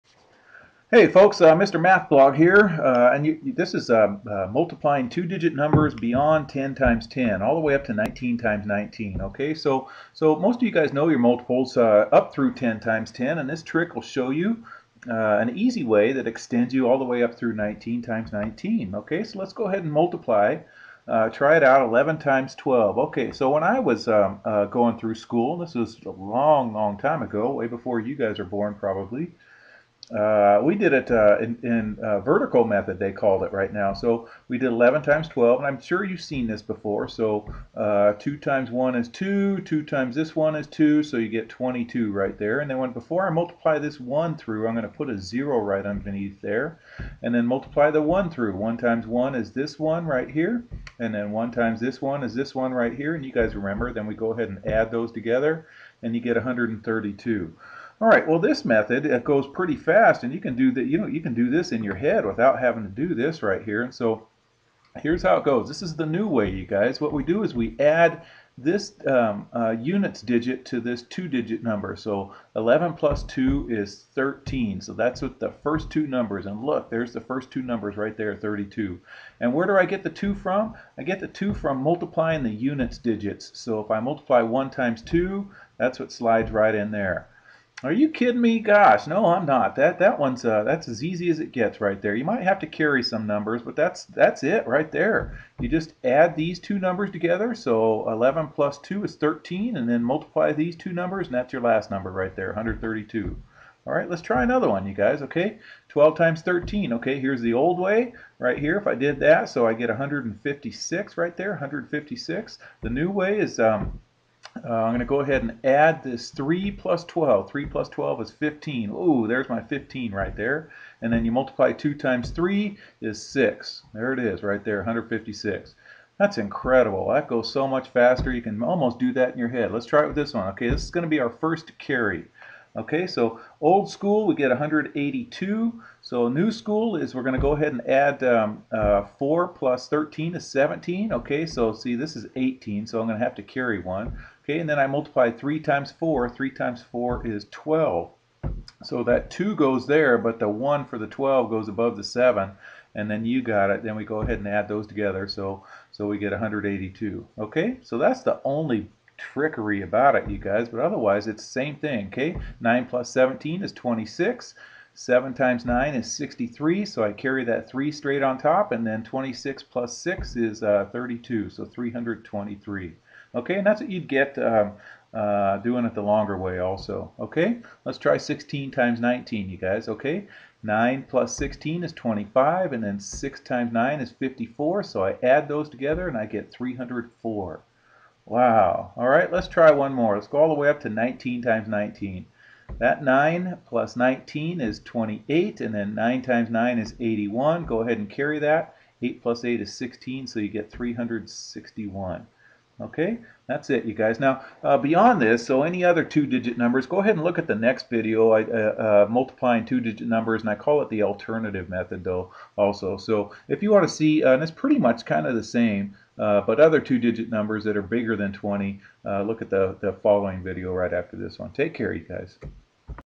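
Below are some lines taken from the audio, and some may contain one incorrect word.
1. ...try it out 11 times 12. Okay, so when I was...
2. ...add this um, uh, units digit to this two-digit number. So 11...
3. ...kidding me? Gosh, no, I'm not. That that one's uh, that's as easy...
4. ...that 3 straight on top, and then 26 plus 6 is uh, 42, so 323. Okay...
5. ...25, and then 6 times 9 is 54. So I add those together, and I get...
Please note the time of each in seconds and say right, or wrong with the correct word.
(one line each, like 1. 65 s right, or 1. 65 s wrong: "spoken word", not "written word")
1. 21 s right
2. 67 s right
3. 88 s right
4. 167 s wrong: "32", not "42"
5. 181 s right.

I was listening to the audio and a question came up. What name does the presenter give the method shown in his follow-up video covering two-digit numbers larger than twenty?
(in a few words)
the alternative method.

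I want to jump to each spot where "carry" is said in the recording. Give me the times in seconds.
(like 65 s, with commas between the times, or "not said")
92 s, 131 s, 143 s, 167 s, 198 s.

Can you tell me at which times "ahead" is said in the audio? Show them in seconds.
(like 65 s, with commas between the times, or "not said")
19 s, 54 s, 115 s, 137 s, 154 s, 197 s, 206 s.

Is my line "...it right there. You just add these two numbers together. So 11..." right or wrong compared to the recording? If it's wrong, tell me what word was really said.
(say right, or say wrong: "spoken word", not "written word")
right.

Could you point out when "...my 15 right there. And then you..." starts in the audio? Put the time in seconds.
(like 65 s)
119 s.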